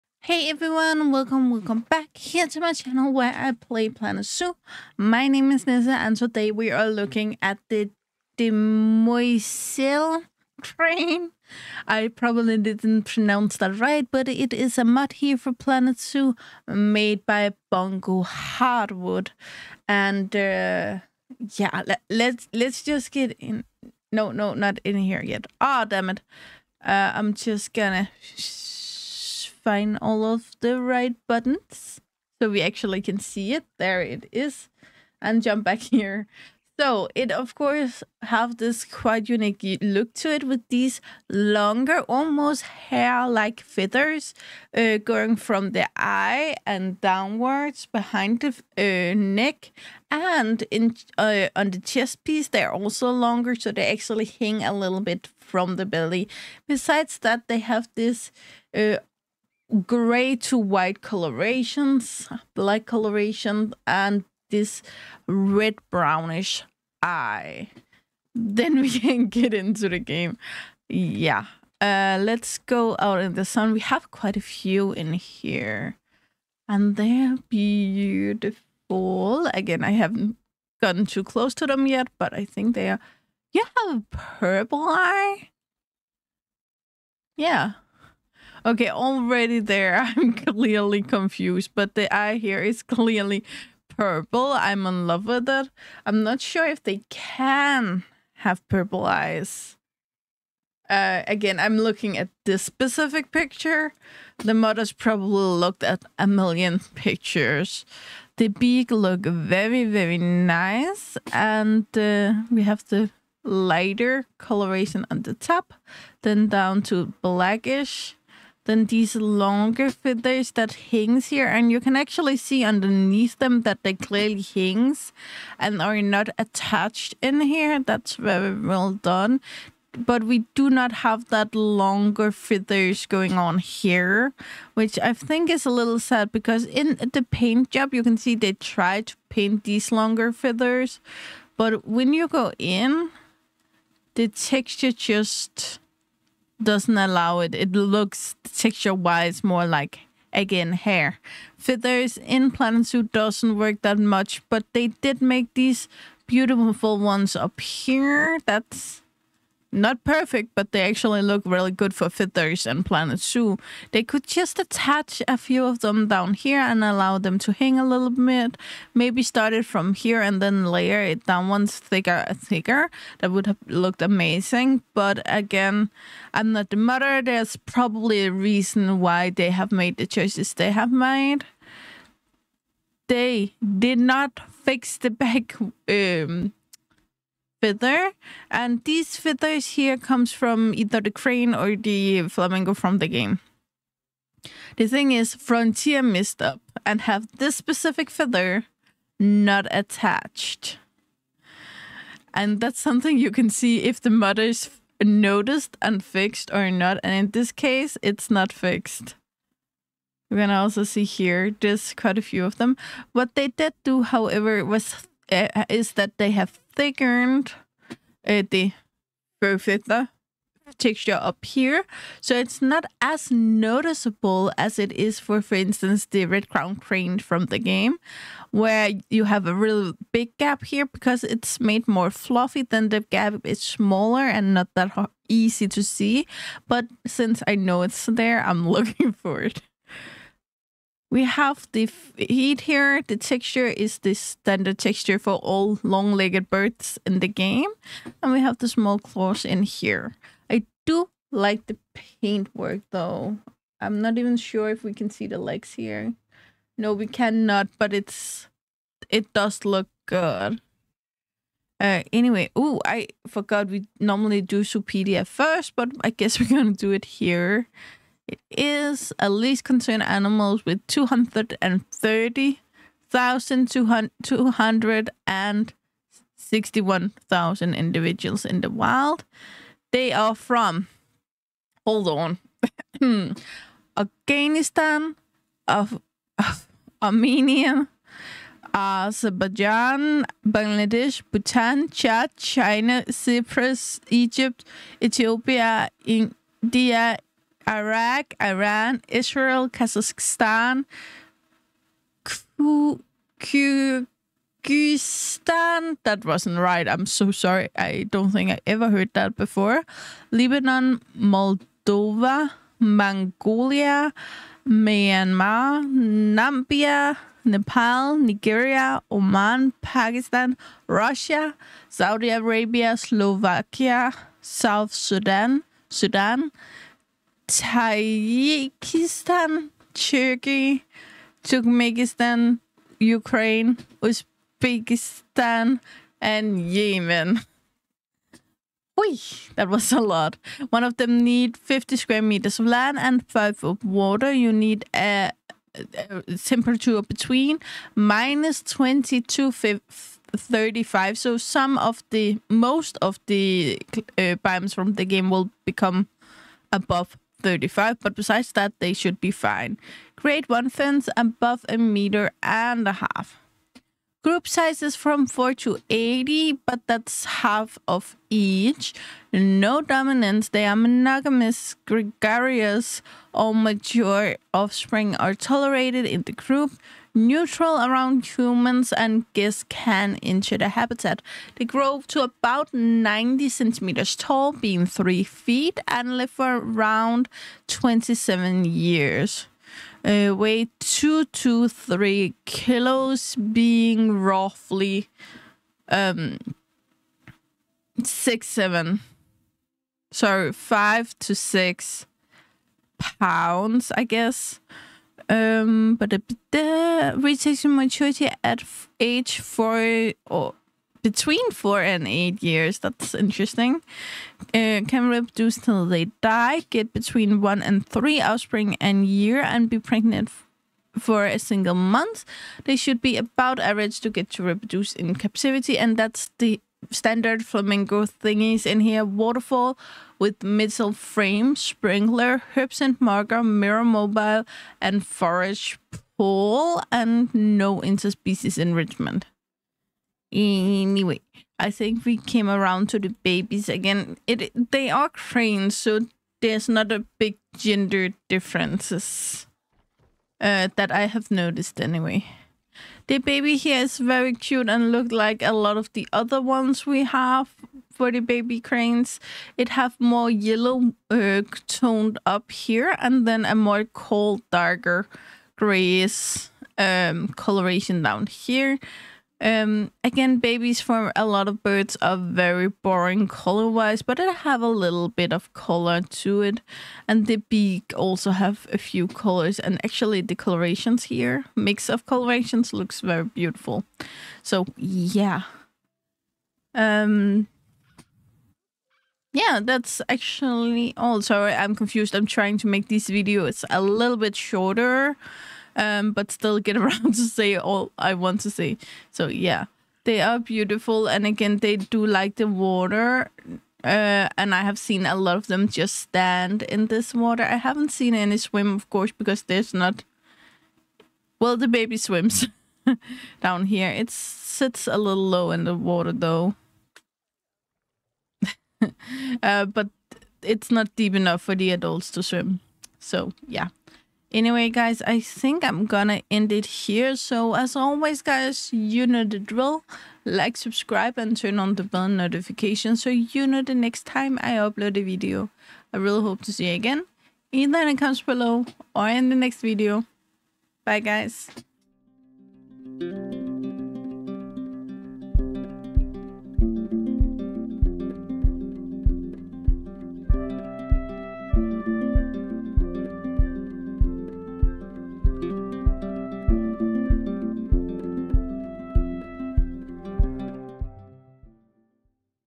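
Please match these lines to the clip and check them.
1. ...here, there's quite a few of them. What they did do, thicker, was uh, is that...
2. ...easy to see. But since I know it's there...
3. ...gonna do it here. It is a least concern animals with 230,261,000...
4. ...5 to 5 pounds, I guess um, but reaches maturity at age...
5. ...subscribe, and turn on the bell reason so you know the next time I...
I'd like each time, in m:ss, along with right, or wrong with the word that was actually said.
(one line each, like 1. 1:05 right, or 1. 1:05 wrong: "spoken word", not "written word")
1. 3:31 wrong: "however", not "thicker"
2. 3:55 right
3. 4:26 right
4. 6:40 wrong: "6", not "5"
5. 8:50 wrong: "notification", not "reason".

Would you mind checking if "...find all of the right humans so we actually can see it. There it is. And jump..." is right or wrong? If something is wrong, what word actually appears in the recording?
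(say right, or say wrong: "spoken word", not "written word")
wrong: "buttons", not "humans".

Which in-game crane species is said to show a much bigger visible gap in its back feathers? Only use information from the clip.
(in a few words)
Red crown crane.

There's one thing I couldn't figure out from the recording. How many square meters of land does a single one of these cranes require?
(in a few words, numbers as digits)
50.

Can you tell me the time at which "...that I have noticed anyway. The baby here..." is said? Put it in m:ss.
7:30.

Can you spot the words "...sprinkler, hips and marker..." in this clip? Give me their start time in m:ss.
7:11.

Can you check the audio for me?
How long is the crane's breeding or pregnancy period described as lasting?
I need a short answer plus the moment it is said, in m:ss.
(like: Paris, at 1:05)
A single month, at 7:01.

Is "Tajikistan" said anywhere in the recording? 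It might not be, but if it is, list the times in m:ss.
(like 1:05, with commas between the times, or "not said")
5:27.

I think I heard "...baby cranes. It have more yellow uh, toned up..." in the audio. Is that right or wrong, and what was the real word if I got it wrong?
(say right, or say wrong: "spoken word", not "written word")
right.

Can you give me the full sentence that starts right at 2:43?
They could just attach a few of them down here and allow them to hang a little bit.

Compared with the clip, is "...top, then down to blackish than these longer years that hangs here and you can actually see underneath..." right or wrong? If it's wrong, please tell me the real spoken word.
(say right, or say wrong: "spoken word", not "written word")
wrong: "feathers", not "years".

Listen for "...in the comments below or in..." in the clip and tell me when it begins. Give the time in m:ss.
8:57.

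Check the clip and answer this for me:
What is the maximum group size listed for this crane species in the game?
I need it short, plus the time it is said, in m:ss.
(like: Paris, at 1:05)
80, at 6:05.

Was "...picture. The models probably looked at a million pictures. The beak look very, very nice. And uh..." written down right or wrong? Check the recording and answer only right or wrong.
right.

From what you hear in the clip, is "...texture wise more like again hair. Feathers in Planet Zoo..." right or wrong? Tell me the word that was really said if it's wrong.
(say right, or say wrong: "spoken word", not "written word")
right.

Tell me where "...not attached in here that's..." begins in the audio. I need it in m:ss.
2:06.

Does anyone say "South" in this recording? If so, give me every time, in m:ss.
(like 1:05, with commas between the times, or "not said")
5:24.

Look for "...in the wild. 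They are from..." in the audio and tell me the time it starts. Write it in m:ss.
4:38.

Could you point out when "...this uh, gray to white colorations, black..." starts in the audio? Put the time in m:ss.
0:57.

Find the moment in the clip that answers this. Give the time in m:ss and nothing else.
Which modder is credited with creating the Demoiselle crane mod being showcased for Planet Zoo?
0:17.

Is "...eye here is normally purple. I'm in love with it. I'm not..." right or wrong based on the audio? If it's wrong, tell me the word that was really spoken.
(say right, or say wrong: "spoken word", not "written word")
wrong: "clearly", not "normally".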